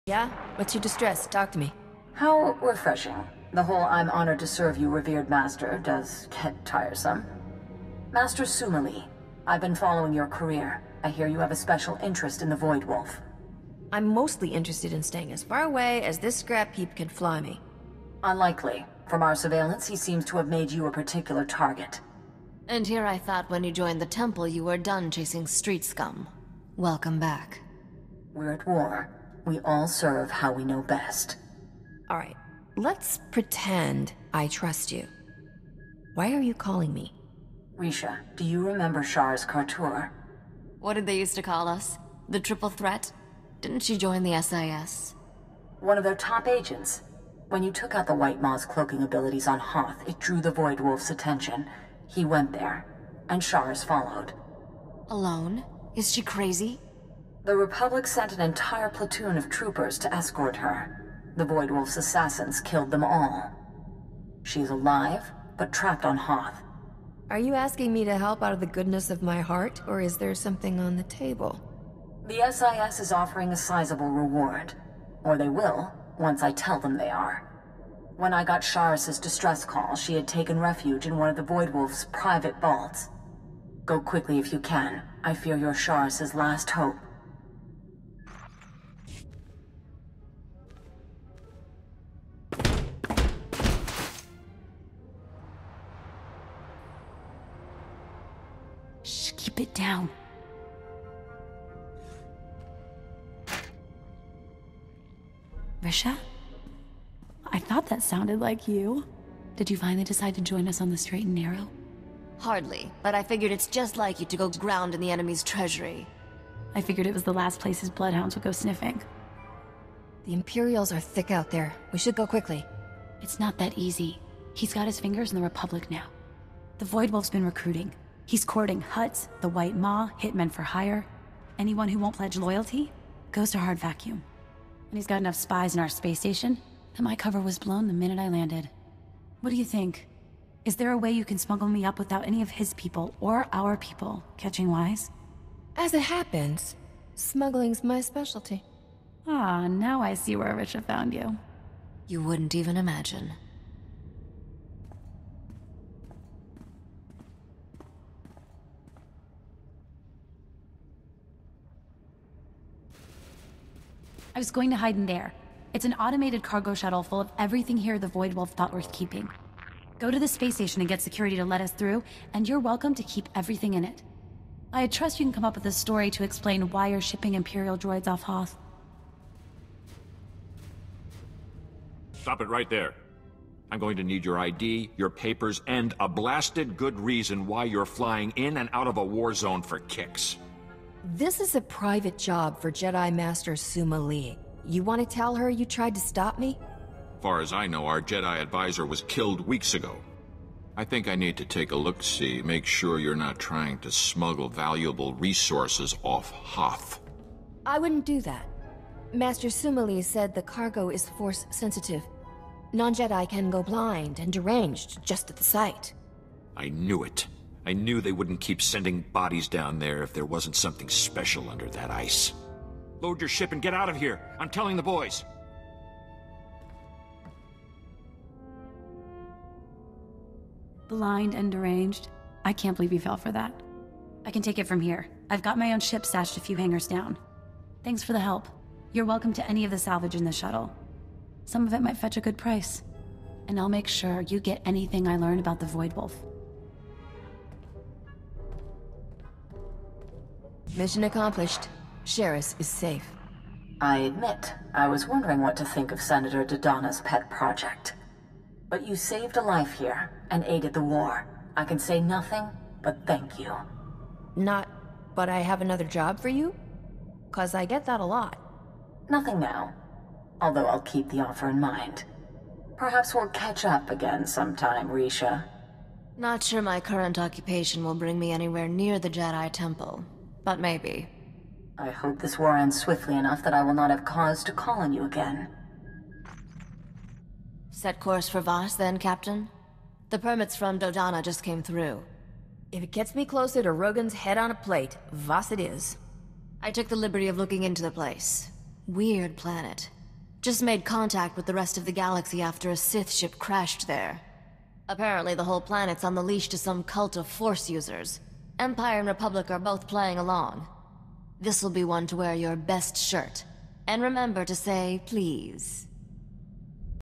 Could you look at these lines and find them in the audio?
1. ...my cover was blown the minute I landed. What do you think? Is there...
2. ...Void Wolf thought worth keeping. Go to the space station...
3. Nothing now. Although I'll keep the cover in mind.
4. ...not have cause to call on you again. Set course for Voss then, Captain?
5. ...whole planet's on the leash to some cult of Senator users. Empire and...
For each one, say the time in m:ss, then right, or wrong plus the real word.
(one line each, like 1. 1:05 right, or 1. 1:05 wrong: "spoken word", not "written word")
1. 2:17 right
2. 2:48 right
3. 4:29 wrong: "offer", not "cover"
4. 4:43 right
5. 5:05 wrong: "Force", not "Senator".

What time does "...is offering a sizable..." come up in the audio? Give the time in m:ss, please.
1:12.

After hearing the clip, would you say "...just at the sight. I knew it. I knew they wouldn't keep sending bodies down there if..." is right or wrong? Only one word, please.
right.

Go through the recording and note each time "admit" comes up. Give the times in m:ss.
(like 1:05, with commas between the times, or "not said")
4:13.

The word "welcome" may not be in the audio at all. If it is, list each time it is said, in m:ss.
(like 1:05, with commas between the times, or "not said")
0:26, 2:52, 3:59.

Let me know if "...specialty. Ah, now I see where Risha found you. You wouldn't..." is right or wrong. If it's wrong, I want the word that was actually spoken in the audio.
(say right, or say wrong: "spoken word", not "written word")
right.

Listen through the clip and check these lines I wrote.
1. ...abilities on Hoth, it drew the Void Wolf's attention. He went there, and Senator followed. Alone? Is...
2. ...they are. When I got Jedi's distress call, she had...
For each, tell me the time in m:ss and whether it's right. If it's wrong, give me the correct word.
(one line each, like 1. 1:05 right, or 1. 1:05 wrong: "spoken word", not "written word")
1. 0:49 wrong: "Shars", not "Senator"
2. 1:16 wrong: "Sharis", not "Jedi".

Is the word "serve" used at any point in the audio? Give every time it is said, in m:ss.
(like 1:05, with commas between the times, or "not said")
0:04, 0:29.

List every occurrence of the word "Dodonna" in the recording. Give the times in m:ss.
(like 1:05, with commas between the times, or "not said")
4:16, 4:50.